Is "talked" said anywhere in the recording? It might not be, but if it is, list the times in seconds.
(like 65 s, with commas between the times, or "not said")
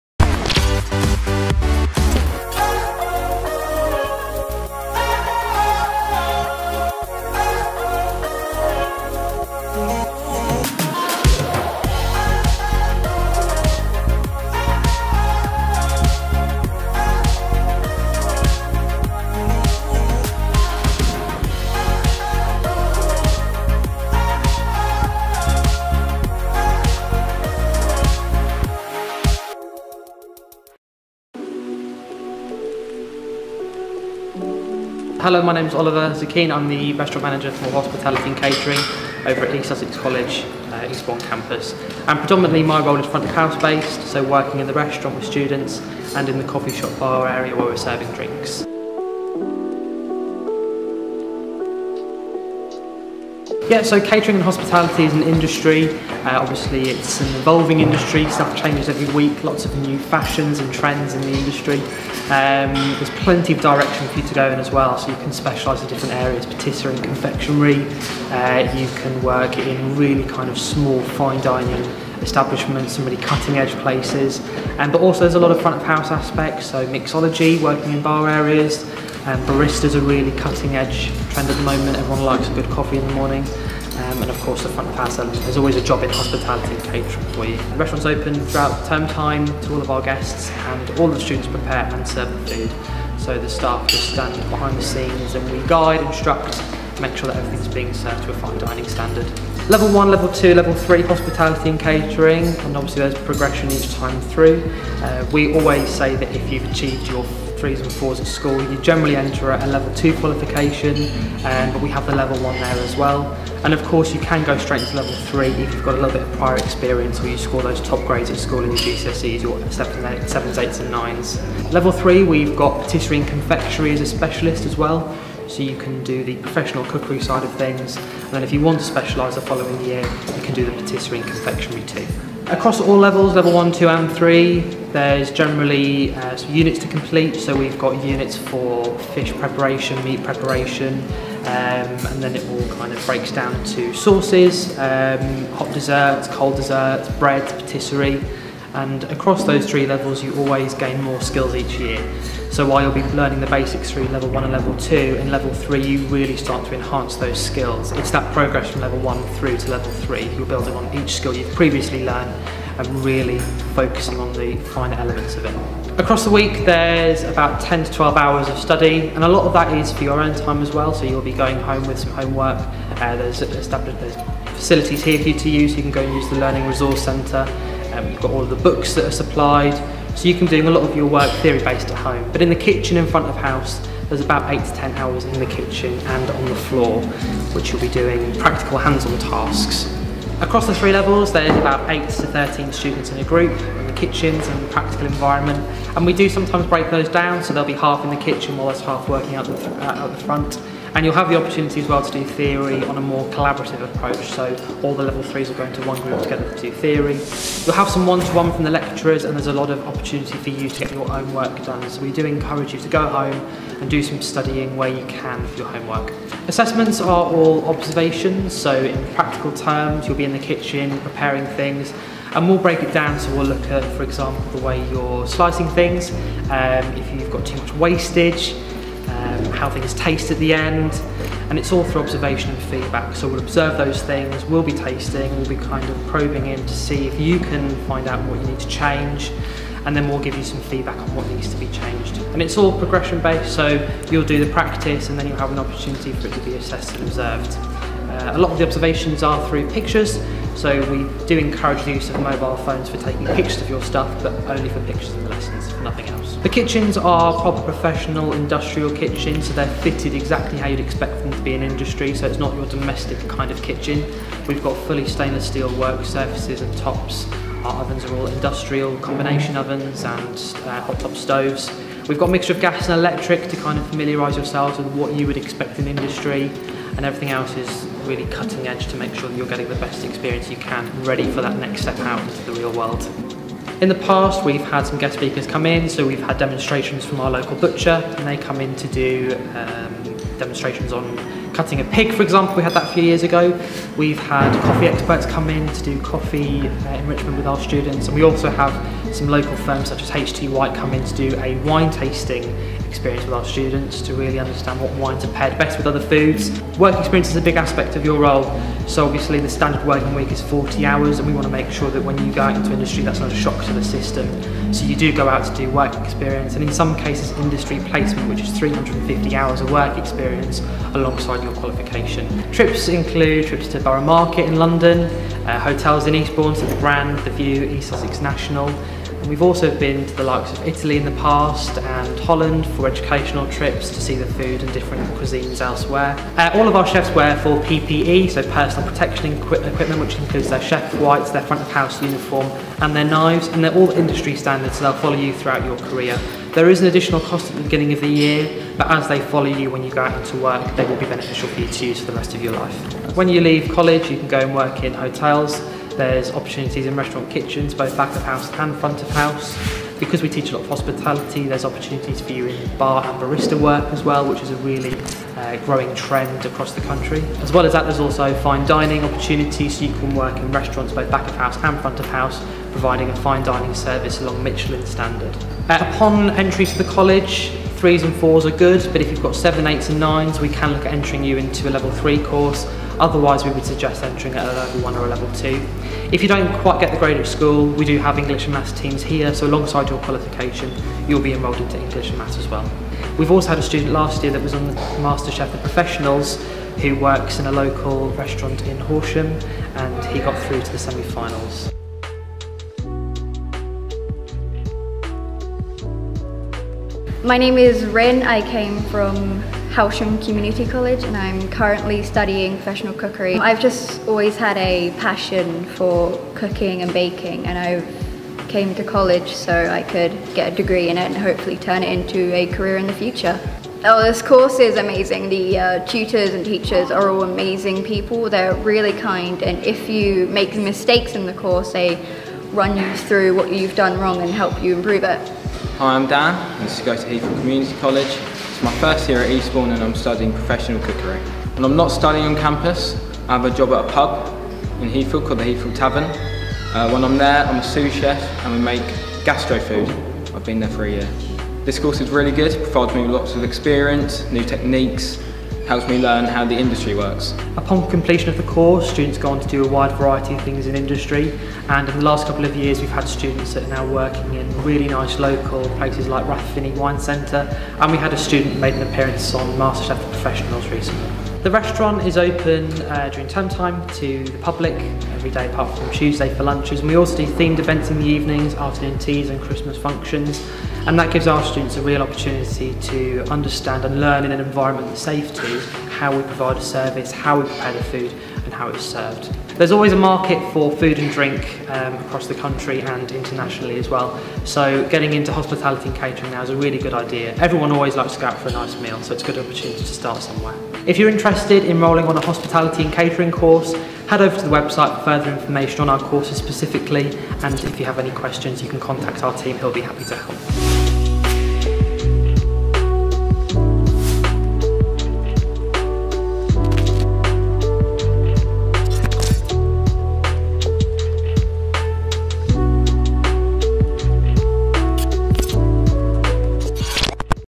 not said.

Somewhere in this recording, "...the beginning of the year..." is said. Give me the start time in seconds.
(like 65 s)
347 s.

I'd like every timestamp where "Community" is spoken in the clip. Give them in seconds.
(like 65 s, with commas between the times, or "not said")
410 s, 437 s.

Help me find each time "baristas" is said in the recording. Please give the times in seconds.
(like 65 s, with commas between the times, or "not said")
79 s, 363 s.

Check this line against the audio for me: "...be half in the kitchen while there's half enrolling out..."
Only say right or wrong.
wrong.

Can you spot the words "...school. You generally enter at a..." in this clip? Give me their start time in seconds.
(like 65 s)
108 s.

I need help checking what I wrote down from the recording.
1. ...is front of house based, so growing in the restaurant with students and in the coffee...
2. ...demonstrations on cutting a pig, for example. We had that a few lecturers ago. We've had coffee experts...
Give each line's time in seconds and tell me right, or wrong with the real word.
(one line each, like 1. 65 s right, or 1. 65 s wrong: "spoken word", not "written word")
1. 42 s wrong: "working", not "growing"
2. 290 s wrong: "years", not "lecturers".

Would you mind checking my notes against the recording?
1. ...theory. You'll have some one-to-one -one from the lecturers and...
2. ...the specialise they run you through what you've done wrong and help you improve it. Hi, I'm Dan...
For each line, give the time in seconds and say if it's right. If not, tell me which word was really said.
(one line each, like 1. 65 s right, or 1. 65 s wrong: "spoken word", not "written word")
1. 206 s right
2. 431 s wrong: "course", not "specialise".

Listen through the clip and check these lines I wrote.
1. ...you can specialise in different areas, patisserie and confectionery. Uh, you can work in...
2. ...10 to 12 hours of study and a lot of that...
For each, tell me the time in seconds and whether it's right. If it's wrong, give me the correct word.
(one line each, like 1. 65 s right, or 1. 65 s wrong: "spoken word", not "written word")
1. 65 s right
2. 167 s right.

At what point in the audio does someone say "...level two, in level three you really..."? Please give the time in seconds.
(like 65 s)
154 s.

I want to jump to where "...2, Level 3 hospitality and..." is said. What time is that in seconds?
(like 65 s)
100 s.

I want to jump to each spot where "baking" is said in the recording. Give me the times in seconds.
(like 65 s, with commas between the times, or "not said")
416 s.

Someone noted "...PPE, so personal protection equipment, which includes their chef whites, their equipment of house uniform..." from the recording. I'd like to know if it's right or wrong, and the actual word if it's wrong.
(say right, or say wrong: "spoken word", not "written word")
wrong: "front", not "equipment".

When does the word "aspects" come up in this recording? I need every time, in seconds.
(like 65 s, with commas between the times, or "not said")
76 s, 307 s.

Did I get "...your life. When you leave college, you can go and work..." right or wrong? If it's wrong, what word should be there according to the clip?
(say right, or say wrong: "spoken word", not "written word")
right.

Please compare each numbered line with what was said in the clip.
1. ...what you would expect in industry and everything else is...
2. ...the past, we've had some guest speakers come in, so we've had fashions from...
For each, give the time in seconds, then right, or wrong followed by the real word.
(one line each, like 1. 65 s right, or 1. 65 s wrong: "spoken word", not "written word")
1. 274 s right
2. 283 s wrong: "demonstrations", not "fashions".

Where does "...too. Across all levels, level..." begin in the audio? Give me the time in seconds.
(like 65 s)
131 s.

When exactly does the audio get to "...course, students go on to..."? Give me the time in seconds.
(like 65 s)
458 s.